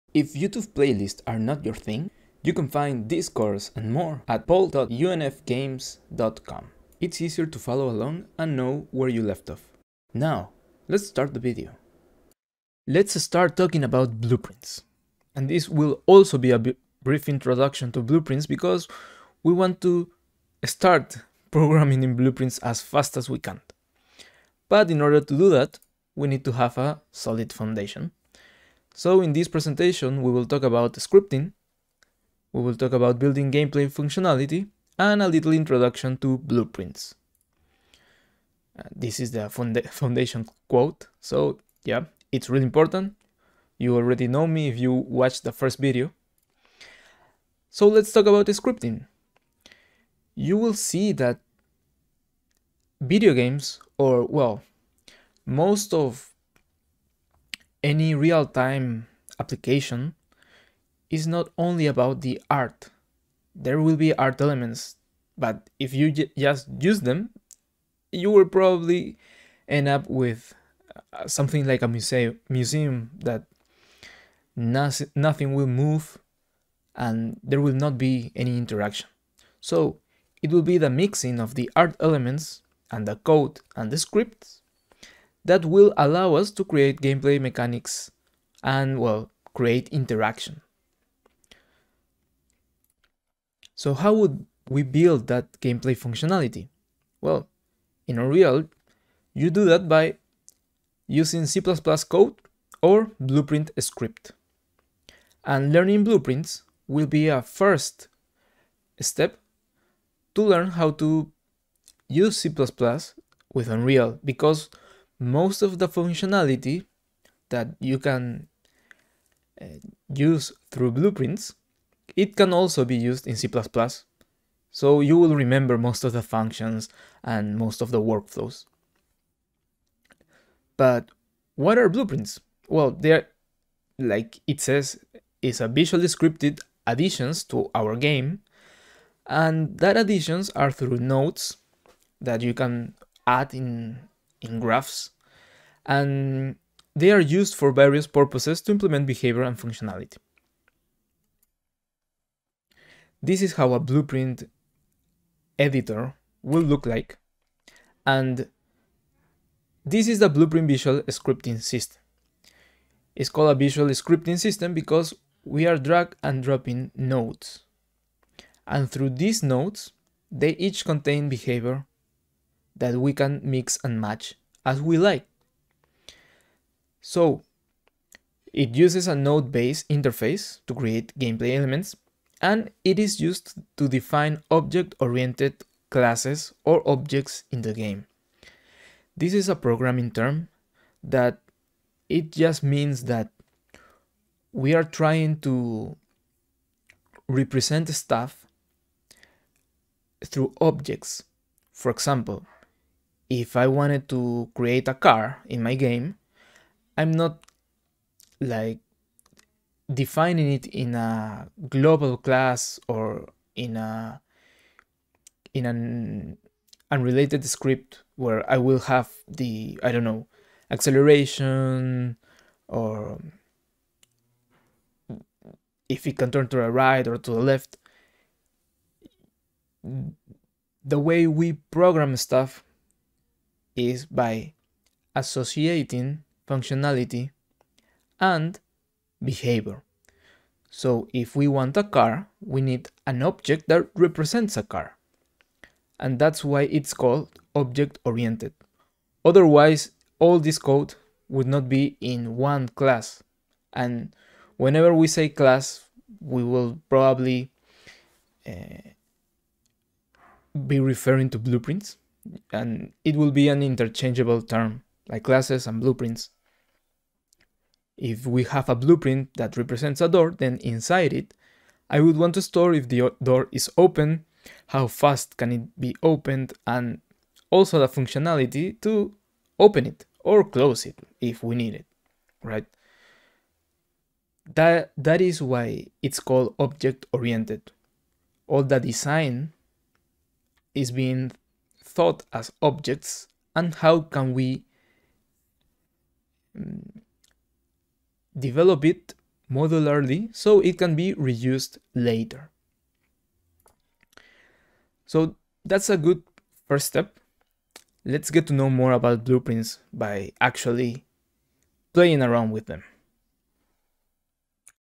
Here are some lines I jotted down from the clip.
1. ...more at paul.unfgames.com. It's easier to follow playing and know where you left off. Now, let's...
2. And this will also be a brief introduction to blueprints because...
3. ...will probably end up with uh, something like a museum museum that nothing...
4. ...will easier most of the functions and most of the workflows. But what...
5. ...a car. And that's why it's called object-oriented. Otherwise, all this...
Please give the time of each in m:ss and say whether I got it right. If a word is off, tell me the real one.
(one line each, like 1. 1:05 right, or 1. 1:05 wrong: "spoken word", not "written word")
1. 0:03 wrong: "along", not "playing"
2. 0:15 right
3. 1:08 right
4. 2:05 wrong: "remember", not "easier"
5. 4:04 right.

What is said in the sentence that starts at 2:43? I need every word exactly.
It's called a visual scripting system because we are drag and dropping nodes.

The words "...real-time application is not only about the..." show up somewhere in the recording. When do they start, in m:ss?
0:58.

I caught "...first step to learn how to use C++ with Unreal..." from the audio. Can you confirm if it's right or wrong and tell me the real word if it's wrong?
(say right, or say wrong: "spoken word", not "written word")
right.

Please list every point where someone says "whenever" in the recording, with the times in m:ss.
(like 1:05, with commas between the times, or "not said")
4:14.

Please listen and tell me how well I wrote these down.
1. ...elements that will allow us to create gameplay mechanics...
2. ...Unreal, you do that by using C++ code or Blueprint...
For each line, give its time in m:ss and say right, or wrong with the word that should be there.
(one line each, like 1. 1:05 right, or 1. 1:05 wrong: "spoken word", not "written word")
1. 1:23 wrong: "scripts", not "elements"
2. 1:38 right.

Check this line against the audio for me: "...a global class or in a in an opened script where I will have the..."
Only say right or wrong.
wrong.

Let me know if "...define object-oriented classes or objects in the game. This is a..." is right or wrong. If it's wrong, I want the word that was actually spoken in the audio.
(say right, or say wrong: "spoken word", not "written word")
right.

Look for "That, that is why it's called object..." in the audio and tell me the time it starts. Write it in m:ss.
4:44.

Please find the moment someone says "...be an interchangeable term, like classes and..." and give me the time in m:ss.
4:23.